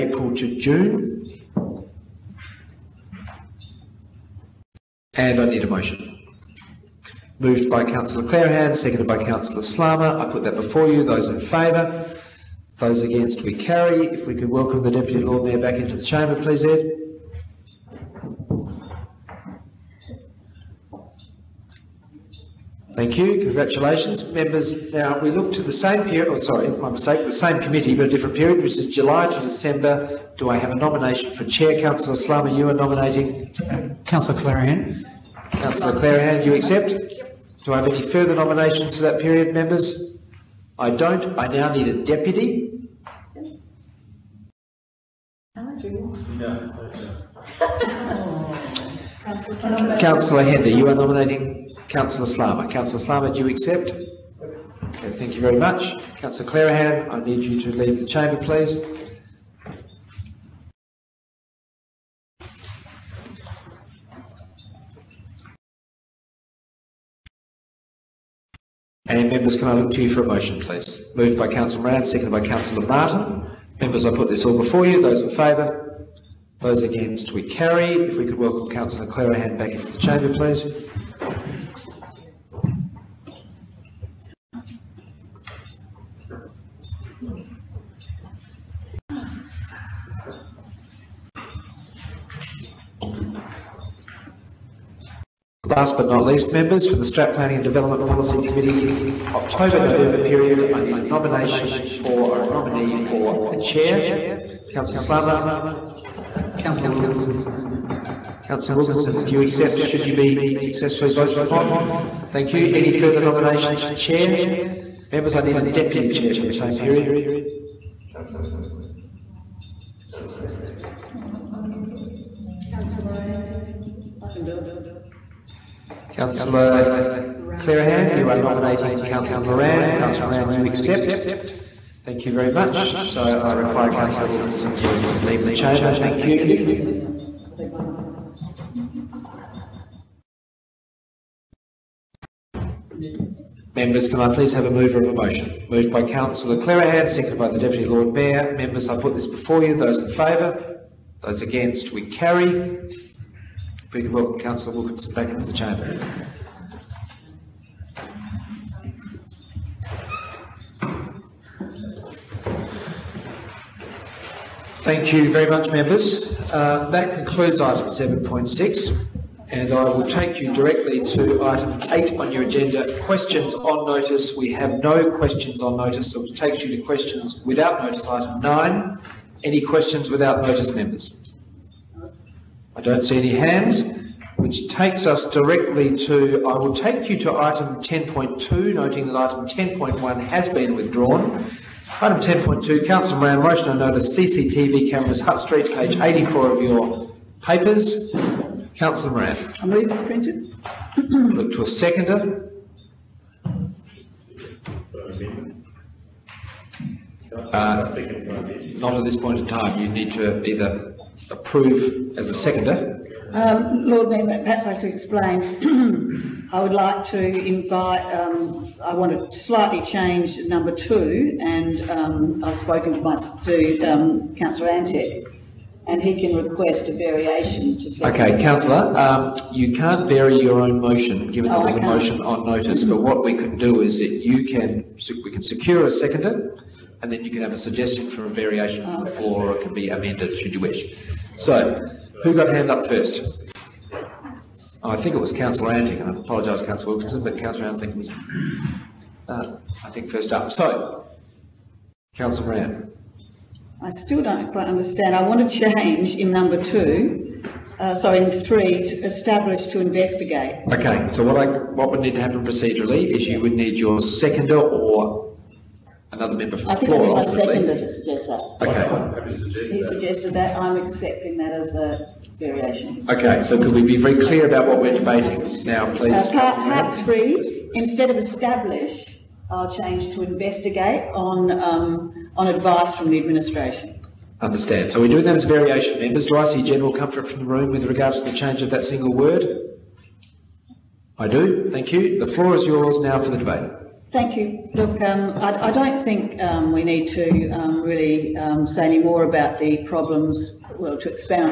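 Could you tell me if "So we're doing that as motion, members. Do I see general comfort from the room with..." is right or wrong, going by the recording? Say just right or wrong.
wrong.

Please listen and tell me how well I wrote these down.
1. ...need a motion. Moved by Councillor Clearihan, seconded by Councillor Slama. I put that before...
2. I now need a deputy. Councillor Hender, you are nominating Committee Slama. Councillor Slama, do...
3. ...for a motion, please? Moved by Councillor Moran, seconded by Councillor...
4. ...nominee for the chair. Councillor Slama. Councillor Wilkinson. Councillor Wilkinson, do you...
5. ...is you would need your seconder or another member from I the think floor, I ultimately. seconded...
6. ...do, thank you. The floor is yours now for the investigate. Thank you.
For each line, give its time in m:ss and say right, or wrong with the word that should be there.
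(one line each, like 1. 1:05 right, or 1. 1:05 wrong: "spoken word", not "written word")
1. 0:05 right
2. 0:41 wrong: "Councillor", not "Committee"
3. 1:10 right
4. 1:42 right
5. 4:23 right
6. 4:51 wrong: "debate", not "investigate".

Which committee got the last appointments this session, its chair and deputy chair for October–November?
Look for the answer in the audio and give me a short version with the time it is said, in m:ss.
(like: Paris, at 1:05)
Strat Planning and Development Policy Committee, at 1:37.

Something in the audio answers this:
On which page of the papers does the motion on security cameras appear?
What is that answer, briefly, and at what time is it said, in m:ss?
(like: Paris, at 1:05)
84, at 3:15.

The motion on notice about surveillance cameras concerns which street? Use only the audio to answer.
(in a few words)
Hutt Street.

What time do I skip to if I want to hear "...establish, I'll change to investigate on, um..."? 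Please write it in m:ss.
4:38.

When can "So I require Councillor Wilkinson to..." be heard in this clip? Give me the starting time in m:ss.
2:13.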